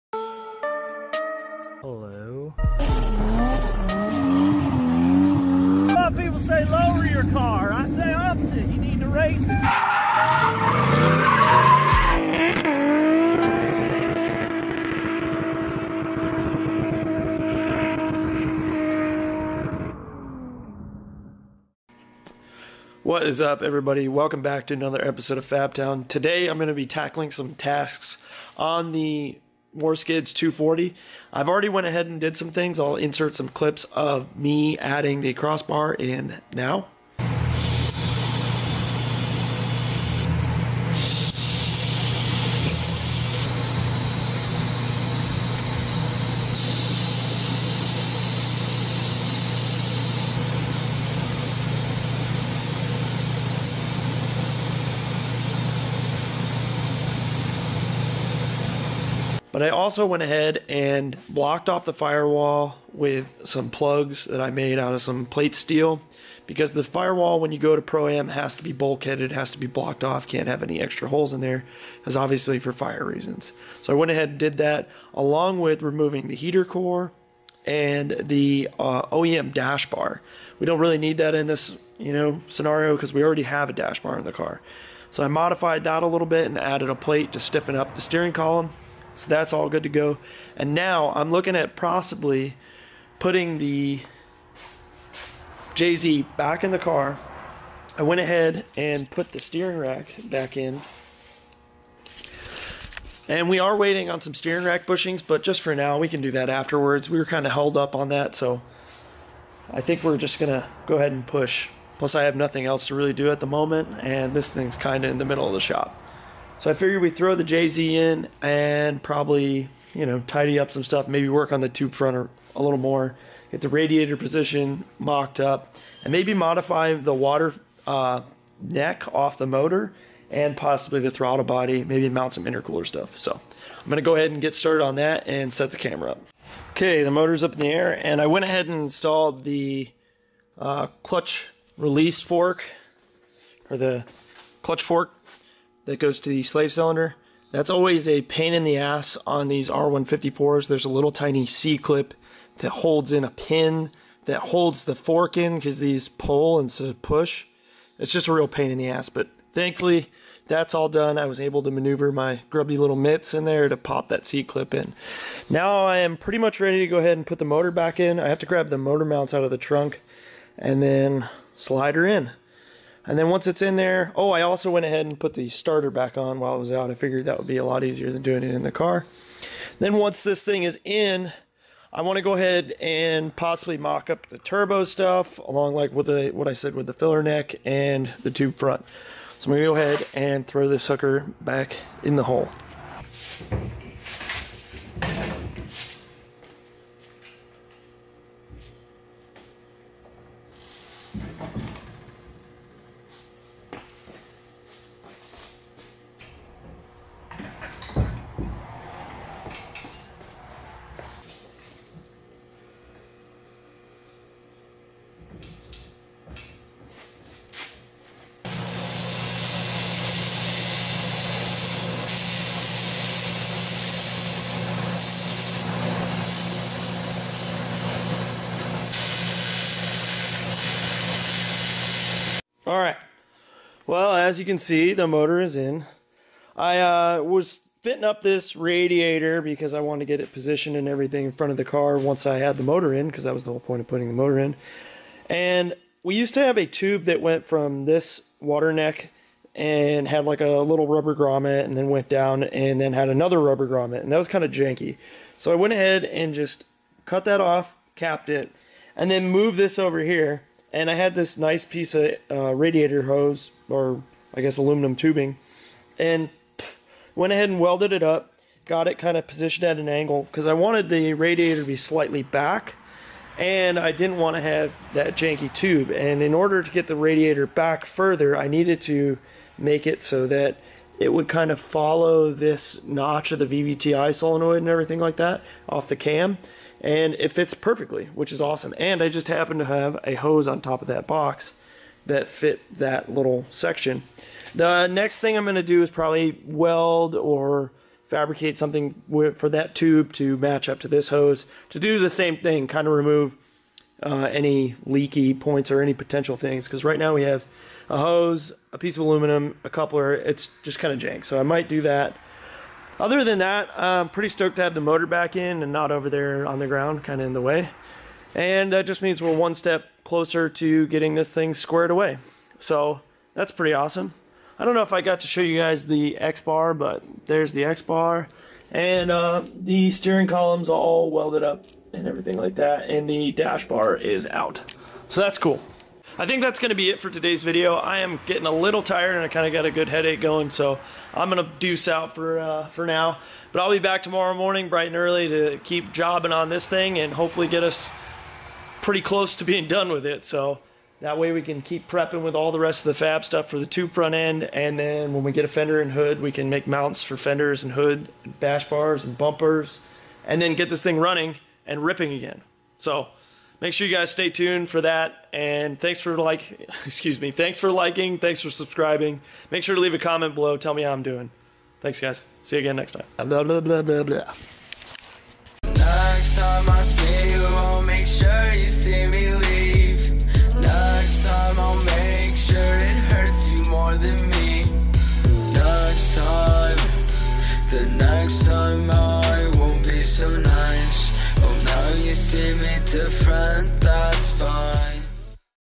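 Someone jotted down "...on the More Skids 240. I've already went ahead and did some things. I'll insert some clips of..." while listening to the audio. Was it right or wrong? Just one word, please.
right.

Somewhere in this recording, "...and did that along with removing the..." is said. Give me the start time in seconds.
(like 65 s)
74 s.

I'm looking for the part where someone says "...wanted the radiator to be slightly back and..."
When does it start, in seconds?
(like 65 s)
270 s.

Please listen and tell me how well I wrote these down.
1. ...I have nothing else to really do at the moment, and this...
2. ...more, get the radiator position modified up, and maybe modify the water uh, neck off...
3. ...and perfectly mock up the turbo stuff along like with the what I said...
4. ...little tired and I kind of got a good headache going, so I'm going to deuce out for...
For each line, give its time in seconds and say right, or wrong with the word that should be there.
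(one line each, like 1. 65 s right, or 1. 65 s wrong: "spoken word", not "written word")
1. 112 s right
2. 122 s wrong: "mocked", not "modified"
3. 182 s wrong: "possibly", not "perfectly"
4. 338 s right.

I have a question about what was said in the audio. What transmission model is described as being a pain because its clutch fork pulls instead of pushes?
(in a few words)
R154.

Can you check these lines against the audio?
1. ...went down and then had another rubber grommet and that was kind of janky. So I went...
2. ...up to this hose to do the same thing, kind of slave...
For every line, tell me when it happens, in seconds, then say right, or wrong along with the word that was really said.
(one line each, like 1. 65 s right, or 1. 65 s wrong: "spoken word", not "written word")
1. 251 s right
2. 300 s wrong: "remove", not "slave".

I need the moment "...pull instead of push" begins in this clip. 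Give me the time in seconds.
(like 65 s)
156 s.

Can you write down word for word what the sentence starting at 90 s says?
And now I'm looking at possibly putting the JZ back in the car.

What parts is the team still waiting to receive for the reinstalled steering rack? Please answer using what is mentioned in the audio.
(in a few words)
Steering rack bushings.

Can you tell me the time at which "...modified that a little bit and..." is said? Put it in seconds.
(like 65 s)
85 s.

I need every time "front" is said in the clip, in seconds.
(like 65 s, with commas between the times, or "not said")
121 s, 188 s, 241 s, 353 s.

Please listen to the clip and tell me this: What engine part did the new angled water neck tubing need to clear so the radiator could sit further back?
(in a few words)
VVTI solenoid.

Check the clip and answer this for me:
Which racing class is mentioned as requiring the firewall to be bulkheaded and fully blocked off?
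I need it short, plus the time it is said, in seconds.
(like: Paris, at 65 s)
Pro-Am, at 67 s.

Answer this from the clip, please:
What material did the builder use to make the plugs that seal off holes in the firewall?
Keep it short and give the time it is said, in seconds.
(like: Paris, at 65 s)
Plate steel, at 65 s.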